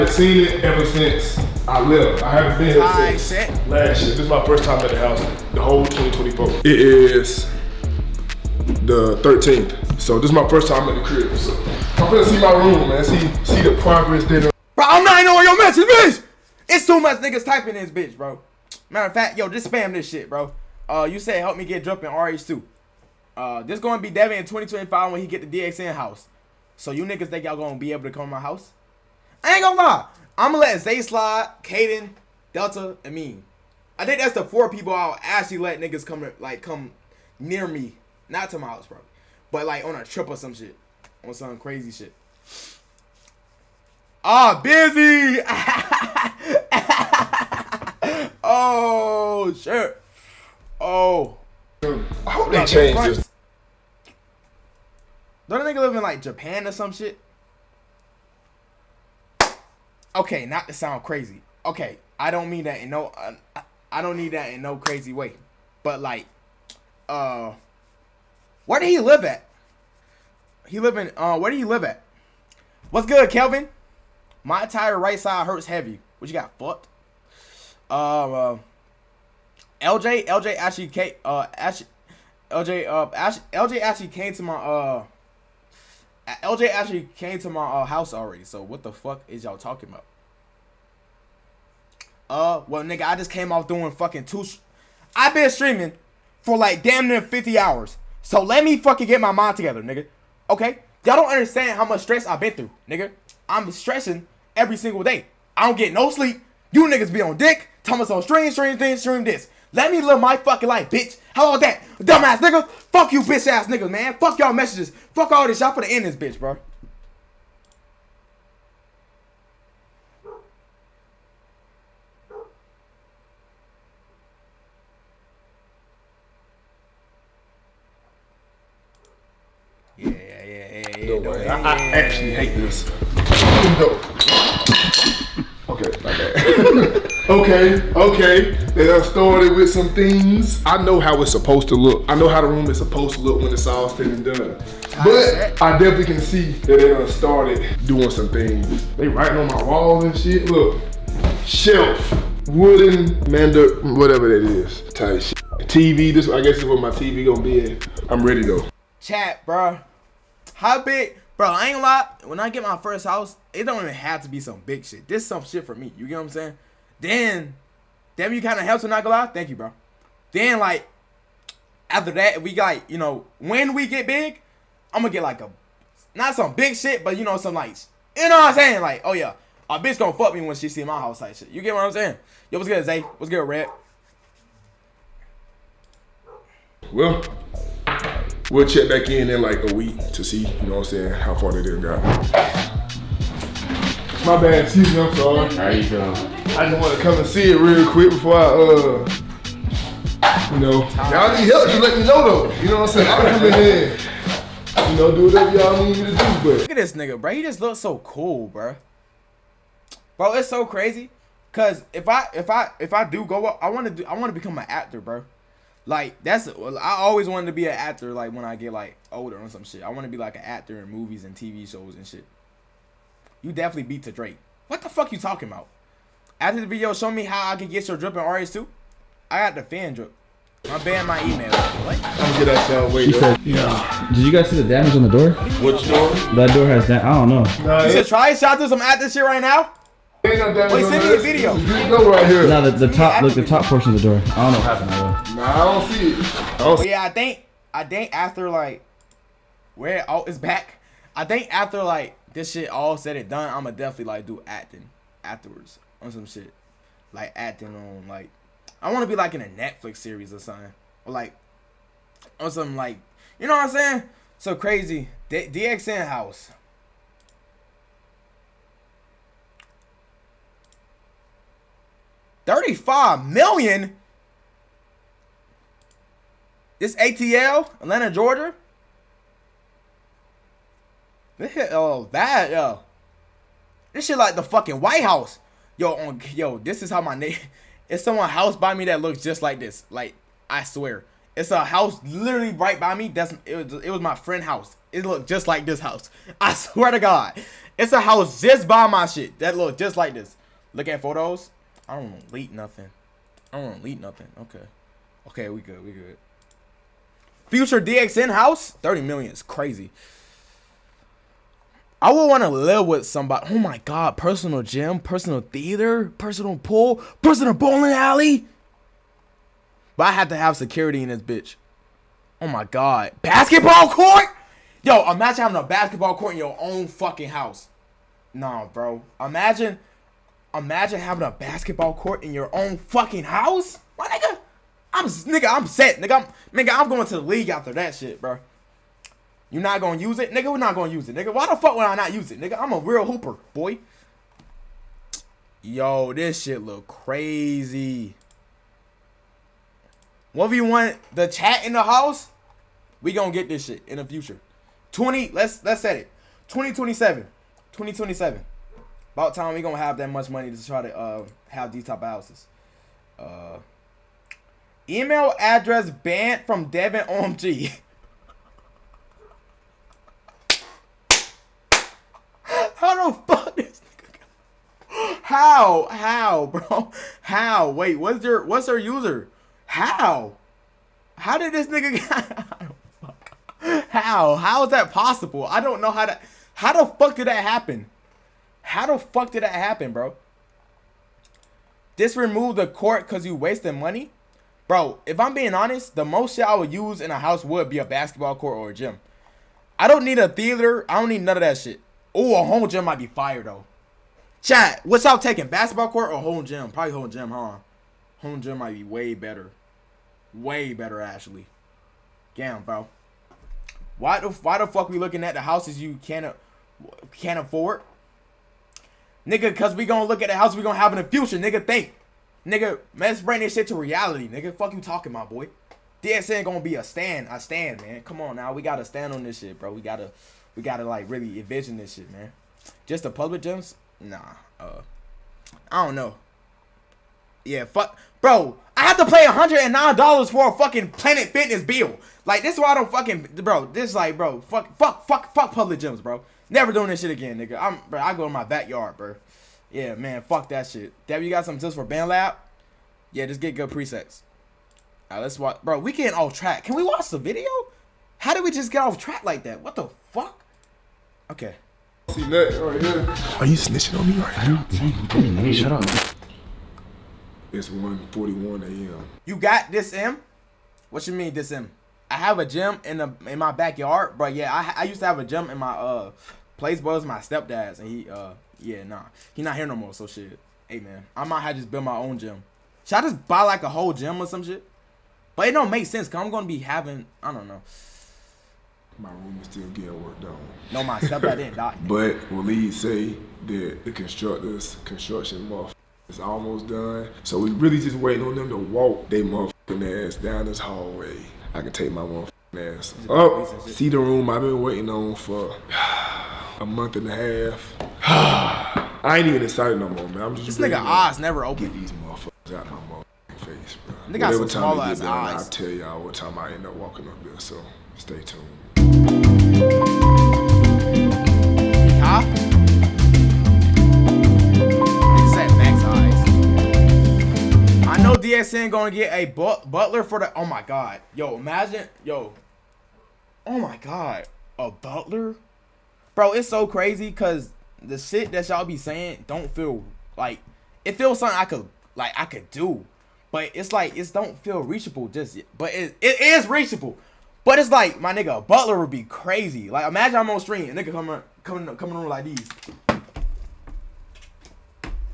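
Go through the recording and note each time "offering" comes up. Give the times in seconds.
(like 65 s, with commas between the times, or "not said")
not said.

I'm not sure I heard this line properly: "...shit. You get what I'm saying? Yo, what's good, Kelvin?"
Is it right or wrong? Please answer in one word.
wrong.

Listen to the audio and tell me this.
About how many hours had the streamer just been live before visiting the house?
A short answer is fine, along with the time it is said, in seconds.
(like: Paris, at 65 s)
50 hours, at 97 s.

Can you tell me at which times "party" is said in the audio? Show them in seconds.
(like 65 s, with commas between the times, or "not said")
not said.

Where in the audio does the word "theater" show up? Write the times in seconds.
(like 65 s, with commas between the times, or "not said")
315 s, 400 s.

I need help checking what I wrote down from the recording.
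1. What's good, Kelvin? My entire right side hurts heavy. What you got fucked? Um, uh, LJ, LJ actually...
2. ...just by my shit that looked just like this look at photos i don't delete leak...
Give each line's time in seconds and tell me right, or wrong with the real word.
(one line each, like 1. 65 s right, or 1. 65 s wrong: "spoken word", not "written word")
1. 72 s right
2. 298 s right.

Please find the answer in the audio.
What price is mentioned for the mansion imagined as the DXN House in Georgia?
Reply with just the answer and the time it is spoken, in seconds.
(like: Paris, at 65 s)
35 million, at 272 s.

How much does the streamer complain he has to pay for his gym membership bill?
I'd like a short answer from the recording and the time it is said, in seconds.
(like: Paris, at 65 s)
$109, at 439 s.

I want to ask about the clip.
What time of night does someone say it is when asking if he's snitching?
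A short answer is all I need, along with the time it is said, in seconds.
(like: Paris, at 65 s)
1:41 a.m., at 467 s.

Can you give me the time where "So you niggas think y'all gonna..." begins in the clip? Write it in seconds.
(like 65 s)
26 s.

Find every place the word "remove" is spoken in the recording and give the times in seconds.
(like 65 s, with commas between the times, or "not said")
392 s.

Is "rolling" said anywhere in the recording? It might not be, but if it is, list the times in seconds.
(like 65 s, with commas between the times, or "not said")
not said.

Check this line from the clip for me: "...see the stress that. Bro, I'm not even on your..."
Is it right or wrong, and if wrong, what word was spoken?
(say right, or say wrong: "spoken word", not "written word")
wrong: "progress", not "stress".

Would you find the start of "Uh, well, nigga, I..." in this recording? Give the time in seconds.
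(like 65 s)
92 s.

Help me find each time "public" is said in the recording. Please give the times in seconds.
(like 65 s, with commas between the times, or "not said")
433 s, 445 s.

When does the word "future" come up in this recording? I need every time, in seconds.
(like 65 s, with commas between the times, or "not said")
307 s, 354 s, 421 s.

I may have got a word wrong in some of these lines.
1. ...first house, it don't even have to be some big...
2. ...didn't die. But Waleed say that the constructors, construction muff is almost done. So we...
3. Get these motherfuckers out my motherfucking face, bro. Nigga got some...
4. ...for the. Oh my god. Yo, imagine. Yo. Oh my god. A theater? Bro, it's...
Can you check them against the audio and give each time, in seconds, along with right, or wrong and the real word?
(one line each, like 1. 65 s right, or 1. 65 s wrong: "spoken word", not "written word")
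1. 162 s right
2. 491 s right
3. 511 s right
4. 530 s wrong: "butler", not "theater".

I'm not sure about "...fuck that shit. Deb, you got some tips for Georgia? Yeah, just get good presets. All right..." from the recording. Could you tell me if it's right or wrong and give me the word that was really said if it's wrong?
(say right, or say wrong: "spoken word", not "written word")
wrong: "BandLab", not "Georgia".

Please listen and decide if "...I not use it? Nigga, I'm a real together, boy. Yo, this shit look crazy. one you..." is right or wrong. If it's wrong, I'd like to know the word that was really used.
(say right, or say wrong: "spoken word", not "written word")
wrong: "hooper", not "together".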